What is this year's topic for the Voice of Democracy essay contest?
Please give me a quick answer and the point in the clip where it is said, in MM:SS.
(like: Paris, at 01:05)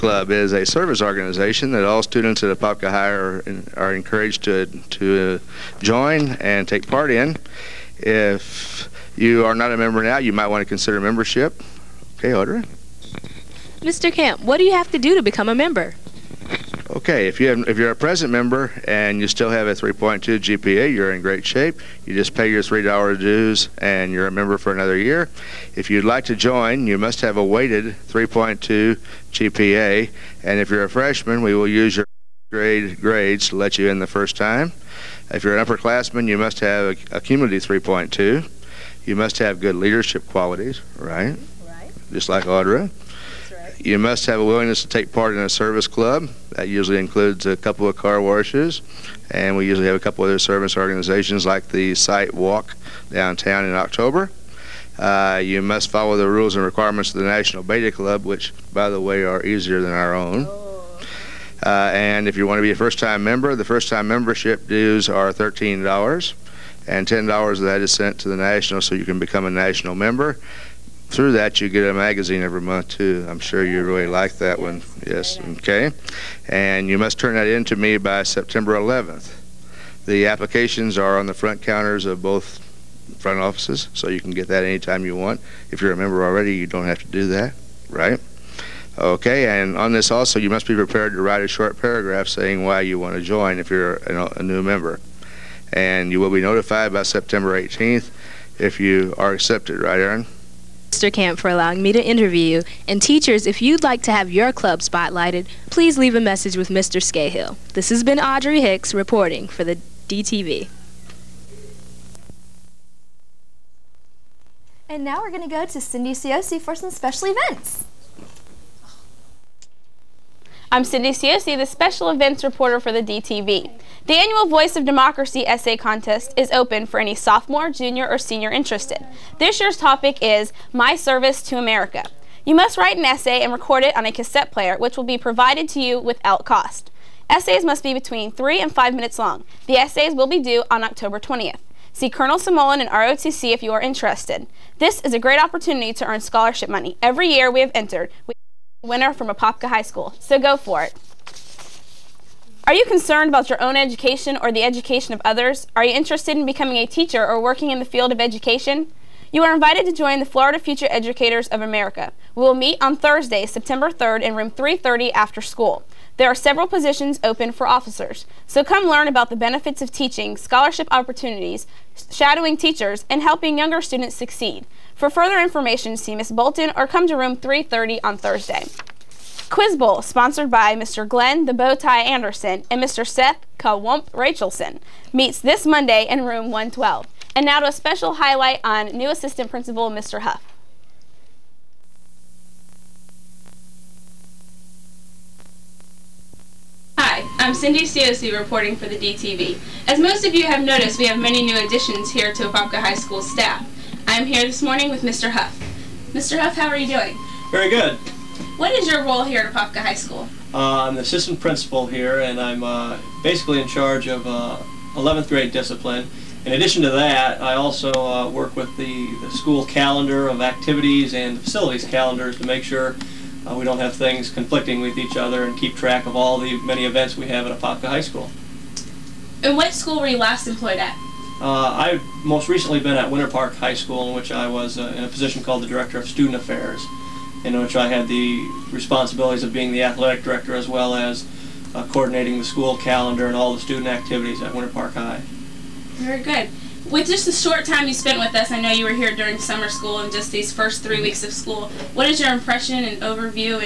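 My Service to America, at 02:10.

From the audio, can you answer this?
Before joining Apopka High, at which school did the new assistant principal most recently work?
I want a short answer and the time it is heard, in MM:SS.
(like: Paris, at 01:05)
Winter Park High School, at 03:53.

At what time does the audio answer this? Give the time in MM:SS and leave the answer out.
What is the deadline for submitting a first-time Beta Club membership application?
01:18.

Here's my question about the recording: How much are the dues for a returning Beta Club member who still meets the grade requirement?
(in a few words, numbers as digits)
$3.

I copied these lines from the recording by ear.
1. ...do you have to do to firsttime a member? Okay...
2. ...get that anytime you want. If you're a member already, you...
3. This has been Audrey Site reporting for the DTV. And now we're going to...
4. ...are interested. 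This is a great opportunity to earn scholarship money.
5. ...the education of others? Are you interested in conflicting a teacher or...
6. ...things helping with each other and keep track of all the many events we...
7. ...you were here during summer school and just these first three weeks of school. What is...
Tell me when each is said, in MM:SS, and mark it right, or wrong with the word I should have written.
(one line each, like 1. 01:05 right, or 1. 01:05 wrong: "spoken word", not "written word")
1. 00:14 wrong: "become", not "firsttime"
2. 01:24 right
3. 01:47 wrong: "Hicks", not "Site"
4. 02:23 right
5. 02:34 wrong: "becoming", not "conflicting"
6. 03:43 wrong: "conflicting", not "helping"
7. 04:08 right.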